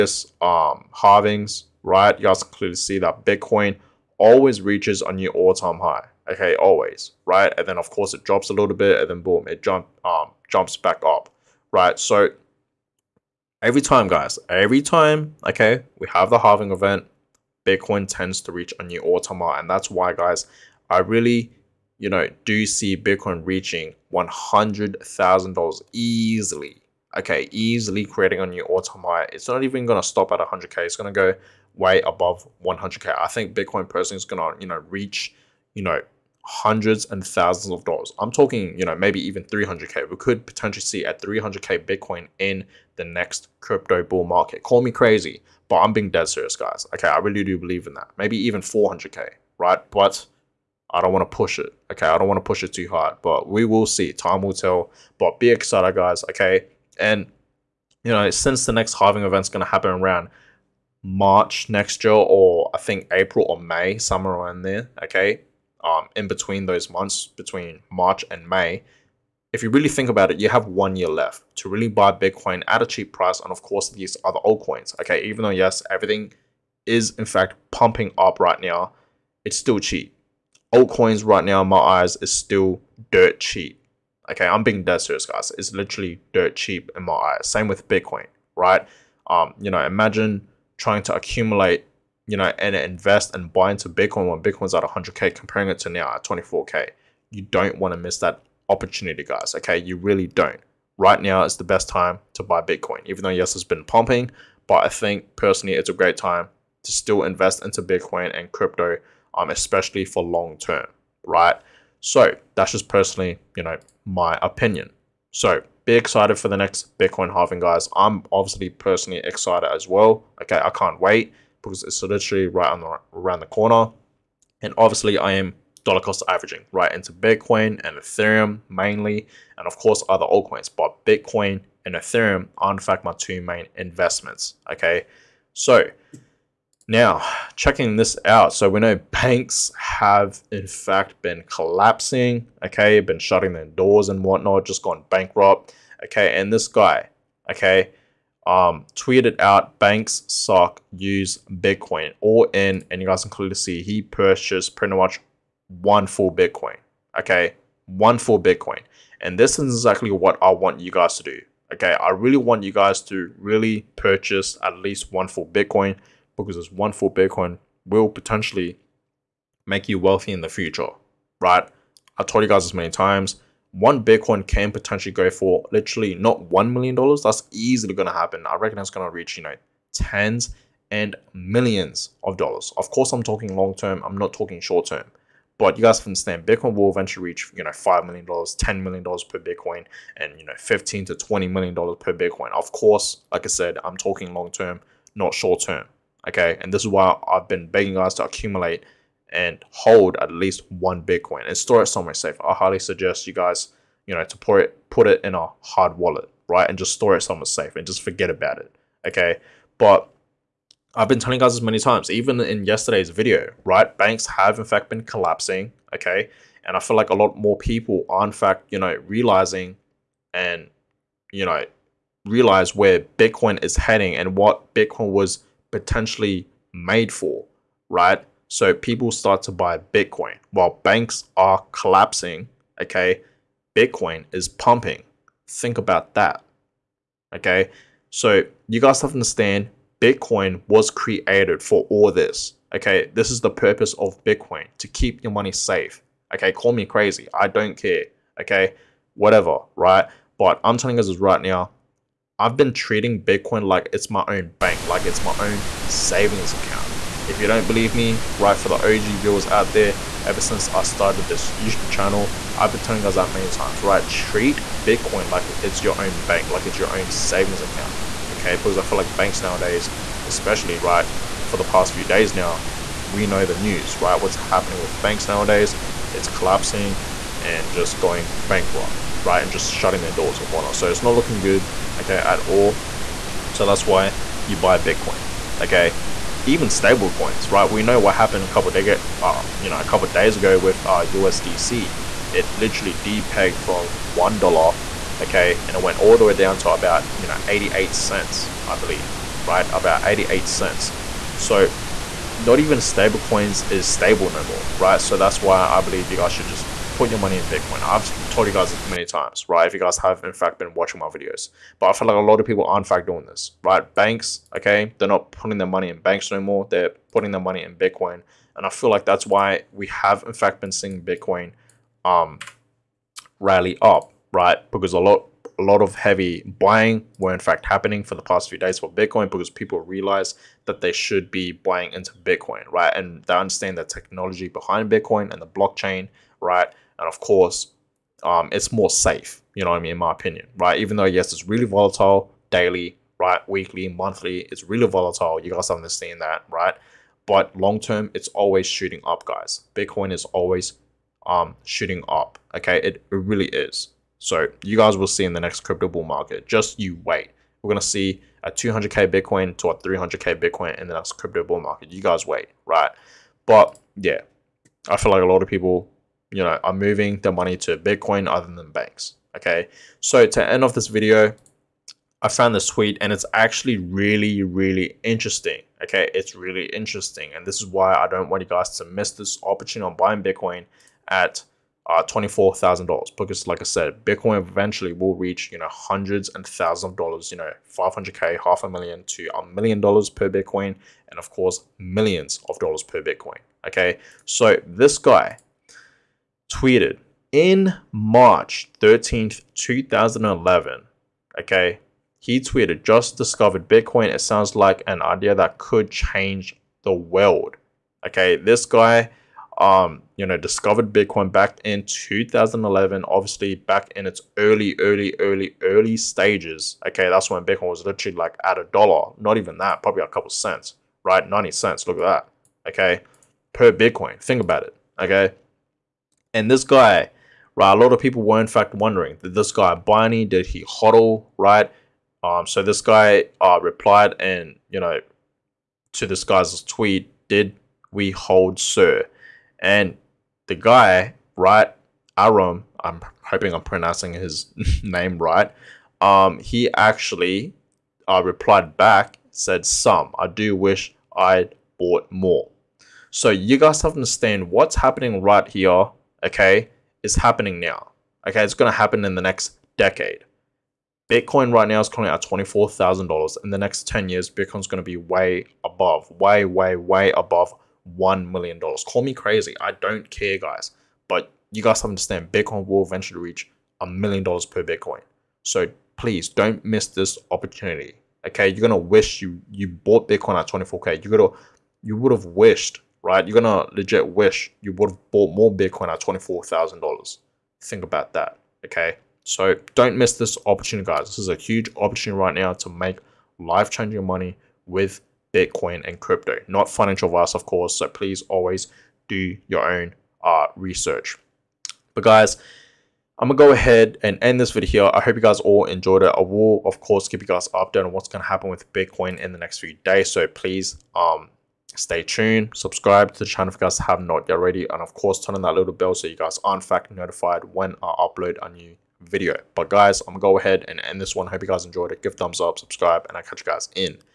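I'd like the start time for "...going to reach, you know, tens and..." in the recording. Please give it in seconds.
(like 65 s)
178 s.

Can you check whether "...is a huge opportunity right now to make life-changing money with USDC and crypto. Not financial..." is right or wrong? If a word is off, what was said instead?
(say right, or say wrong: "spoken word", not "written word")
wrong: "Bitcoin", not "USDC".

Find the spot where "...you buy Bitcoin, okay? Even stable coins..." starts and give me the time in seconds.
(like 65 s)
284 s.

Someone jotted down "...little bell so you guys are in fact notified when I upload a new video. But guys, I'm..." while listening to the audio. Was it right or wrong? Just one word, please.
right.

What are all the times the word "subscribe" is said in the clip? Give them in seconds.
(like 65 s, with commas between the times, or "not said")
512 s, 522 s.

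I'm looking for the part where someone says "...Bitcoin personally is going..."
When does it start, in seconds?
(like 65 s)
33 s.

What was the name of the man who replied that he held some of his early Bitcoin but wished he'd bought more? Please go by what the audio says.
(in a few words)
Aram.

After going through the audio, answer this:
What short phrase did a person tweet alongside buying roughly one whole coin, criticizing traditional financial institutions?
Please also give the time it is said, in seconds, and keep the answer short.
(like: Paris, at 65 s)
banks suck, at 149 s.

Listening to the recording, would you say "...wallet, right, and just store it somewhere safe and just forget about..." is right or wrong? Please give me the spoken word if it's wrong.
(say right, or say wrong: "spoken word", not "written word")
right.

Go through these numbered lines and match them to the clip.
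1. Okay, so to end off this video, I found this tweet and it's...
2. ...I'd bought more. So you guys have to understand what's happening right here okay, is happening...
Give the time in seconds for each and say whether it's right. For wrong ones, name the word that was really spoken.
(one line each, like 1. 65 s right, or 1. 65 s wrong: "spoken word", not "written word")
1. 369 s right
2. 451 s right.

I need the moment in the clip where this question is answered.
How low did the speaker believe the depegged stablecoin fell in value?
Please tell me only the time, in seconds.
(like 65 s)
297 s.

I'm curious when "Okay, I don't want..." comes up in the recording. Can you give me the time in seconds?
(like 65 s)
51 s.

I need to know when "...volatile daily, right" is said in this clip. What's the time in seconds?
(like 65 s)
341 s.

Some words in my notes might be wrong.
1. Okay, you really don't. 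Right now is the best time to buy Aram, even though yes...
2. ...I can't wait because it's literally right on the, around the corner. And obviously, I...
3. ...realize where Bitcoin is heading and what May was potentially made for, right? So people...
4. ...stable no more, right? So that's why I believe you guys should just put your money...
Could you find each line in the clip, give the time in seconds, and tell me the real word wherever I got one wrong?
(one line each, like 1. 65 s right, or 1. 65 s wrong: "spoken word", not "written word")
1. 99 s wrong: "Bitcoin", not "Aram"
2. 120 s right
3. 222 s wrong: "Bitcoin", not "May"
4. 303 s right.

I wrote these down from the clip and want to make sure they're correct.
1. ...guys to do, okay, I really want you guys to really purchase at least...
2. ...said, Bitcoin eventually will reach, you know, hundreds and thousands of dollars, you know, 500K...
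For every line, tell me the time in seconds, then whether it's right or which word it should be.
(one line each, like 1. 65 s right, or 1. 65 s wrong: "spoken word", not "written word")
1. 160 s right
2. 383 s right.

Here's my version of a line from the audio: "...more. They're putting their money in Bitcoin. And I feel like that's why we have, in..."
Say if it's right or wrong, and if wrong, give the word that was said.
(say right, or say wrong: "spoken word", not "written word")
right.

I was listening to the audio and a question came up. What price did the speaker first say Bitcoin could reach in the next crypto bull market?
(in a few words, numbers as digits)
300K.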